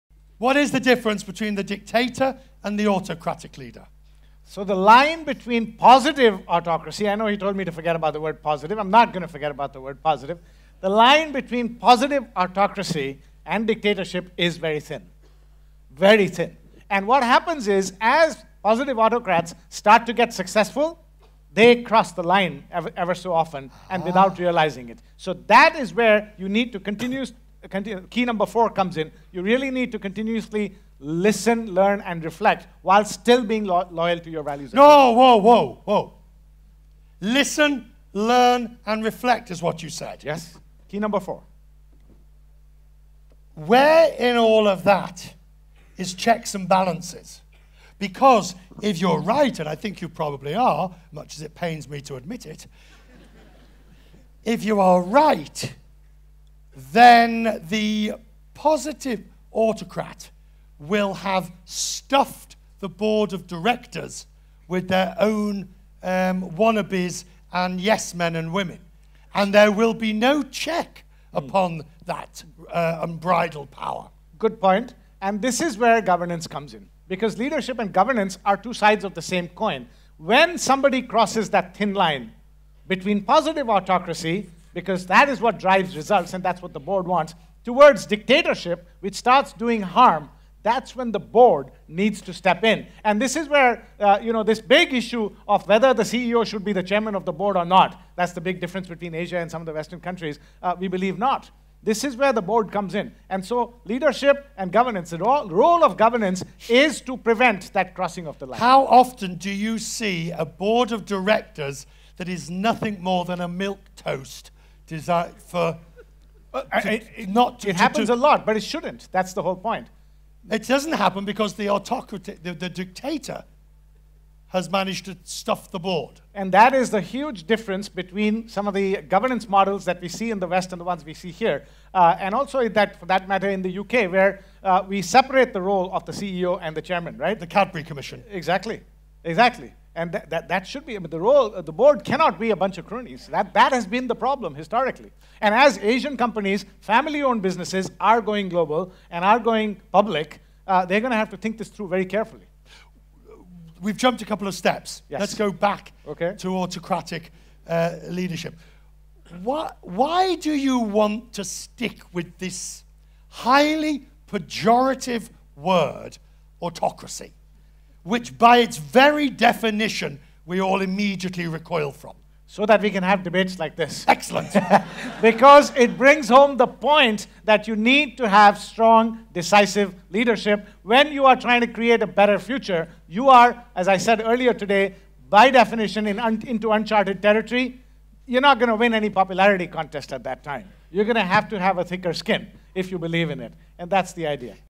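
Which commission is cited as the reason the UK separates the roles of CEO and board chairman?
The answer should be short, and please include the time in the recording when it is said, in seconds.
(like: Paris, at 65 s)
The Cadbury Commission, at 137 s.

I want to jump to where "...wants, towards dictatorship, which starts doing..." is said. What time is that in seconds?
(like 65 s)
87 s.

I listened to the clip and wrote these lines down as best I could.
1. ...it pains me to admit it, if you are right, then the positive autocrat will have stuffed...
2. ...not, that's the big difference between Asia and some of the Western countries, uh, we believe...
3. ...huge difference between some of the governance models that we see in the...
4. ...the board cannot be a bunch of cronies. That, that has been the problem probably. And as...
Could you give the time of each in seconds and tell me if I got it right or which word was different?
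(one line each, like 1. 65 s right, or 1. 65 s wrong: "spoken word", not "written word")
1. 51 s right
2. 97 s right
3. 126 s right
4. 141 s wrong: "historically", not "probably".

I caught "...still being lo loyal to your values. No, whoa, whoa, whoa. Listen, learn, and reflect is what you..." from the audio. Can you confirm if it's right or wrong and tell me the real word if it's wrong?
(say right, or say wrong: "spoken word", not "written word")
right.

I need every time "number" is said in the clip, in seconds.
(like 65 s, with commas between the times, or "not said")
28 s, 40 s.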